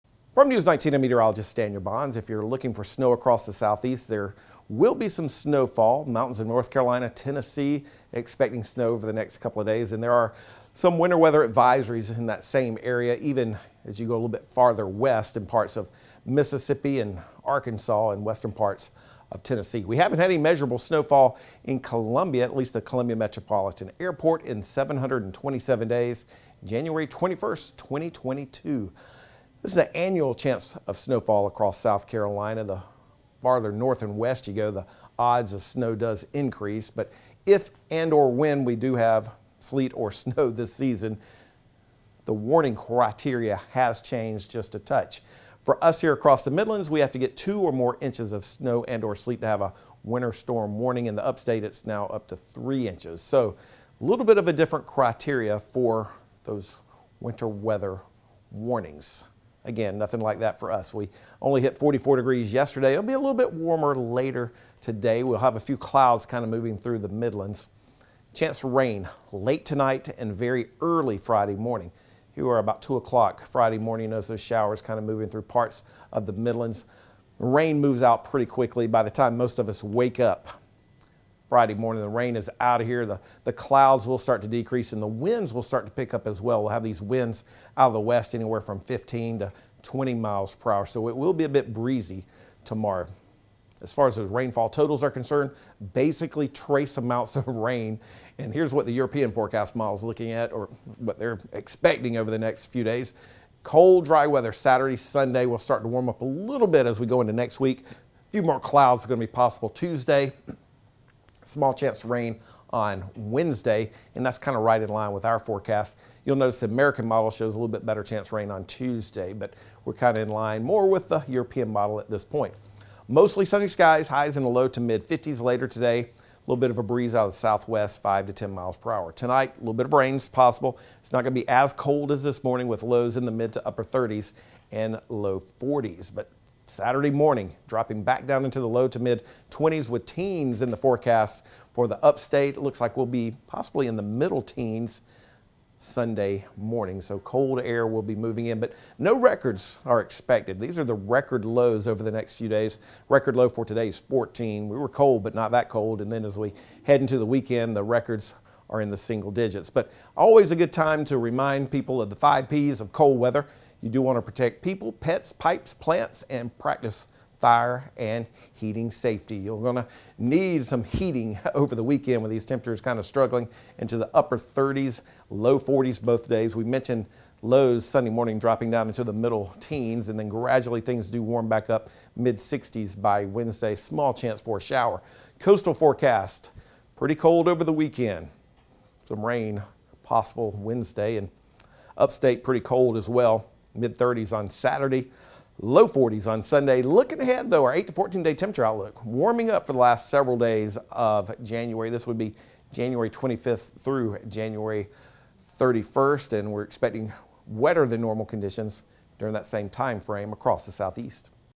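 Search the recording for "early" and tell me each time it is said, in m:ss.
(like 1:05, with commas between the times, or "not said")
1:10.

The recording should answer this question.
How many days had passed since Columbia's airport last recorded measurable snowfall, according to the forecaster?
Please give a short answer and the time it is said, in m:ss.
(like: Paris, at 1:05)
727, at 0:24.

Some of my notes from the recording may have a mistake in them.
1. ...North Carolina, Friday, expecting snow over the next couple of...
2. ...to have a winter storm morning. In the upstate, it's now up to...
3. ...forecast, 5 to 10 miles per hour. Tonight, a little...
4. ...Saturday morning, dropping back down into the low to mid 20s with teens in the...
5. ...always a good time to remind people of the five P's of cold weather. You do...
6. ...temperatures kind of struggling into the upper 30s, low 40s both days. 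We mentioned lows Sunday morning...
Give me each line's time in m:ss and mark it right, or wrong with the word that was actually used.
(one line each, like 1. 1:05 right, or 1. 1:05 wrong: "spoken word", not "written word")
1. 0:06 wrong: "Tennessee", not "Friday"
2. 0:49 wrong: "warning", not "morning"
3. 2:07 wrong: "southwest", not "forecast"
4. 2:16 right
5. 2:40 right
6. 2:52 right.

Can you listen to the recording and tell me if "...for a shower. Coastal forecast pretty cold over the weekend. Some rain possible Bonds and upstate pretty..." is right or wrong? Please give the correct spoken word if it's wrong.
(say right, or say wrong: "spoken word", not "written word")
wrong: "Wednesday", not "Bonds".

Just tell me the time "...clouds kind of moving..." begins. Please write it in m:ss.
1:05.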